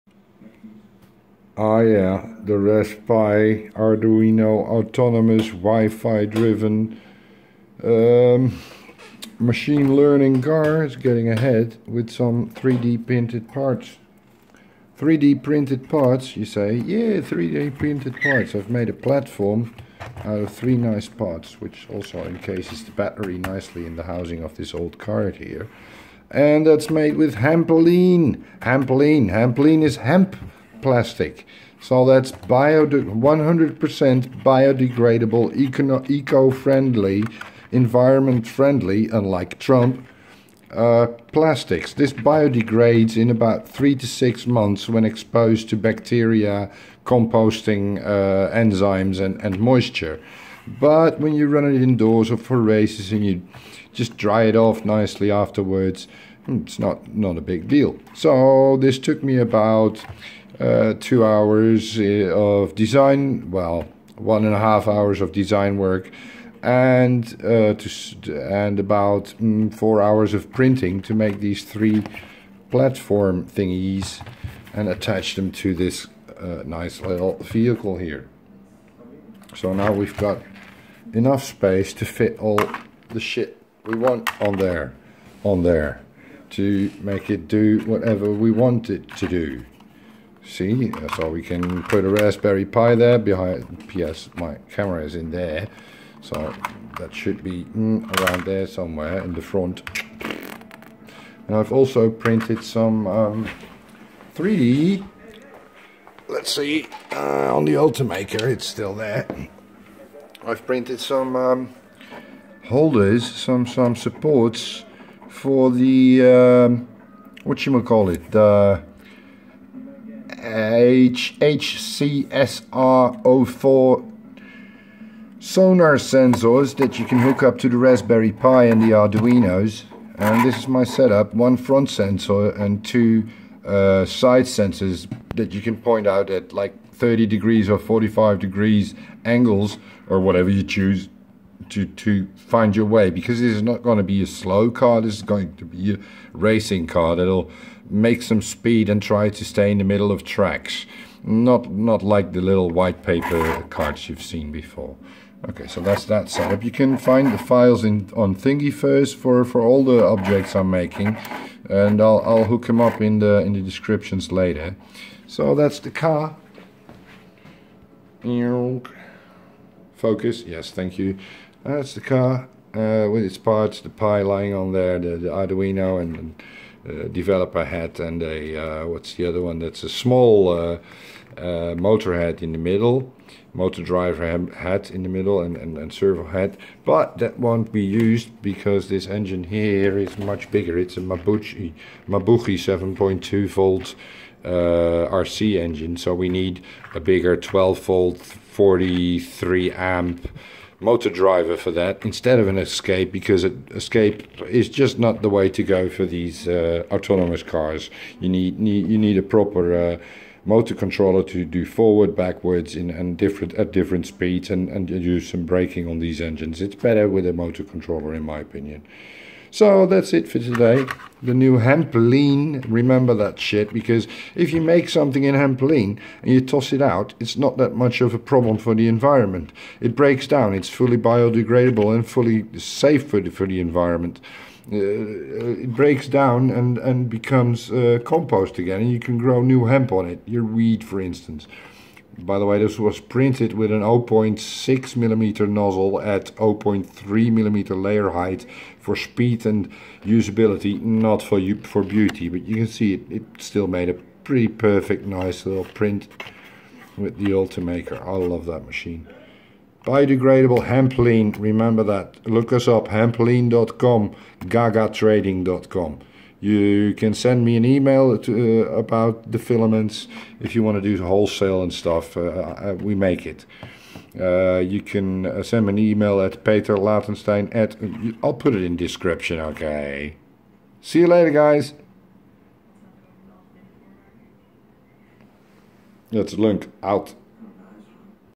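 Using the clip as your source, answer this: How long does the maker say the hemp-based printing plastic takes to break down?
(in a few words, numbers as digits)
3 to 6 months.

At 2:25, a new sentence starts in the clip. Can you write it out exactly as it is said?
This is going to be a racing car that'll make some speed and try to stay in the middle of tracks.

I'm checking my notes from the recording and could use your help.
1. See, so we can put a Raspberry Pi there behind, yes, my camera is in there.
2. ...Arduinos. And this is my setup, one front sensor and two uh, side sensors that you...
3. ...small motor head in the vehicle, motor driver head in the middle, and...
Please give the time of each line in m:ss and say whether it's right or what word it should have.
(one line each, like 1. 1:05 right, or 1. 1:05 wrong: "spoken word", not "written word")
1. 1:30 right
2. 2:08 right
3. 2:59 wrong: "middle", not "vehicle".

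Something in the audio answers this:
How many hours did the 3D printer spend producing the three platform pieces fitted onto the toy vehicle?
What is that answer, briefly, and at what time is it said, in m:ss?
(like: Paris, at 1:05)
4 hours, at 1:09.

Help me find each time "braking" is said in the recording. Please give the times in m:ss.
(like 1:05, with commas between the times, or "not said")
3:35.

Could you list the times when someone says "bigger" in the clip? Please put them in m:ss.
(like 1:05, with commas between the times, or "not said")
3:10, 3:16.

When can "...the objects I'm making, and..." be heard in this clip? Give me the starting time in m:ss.
2:39.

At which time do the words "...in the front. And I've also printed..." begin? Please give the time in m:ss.
1:39.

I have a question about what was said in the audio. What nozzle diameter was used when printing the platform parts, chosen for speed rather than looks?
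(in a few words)
0.6 mm.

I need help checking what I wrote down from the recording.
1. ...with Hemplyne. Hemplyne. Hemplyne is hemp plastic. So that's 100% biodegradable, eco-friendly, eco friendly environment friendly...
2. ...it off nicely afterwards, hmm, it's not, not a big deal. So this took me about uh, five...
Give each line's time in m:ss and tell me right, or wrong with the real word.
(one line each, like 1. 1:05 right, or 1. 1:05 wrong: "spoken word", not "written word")
1. 0:27 right
2. 0:54 wrong: "two", not "five".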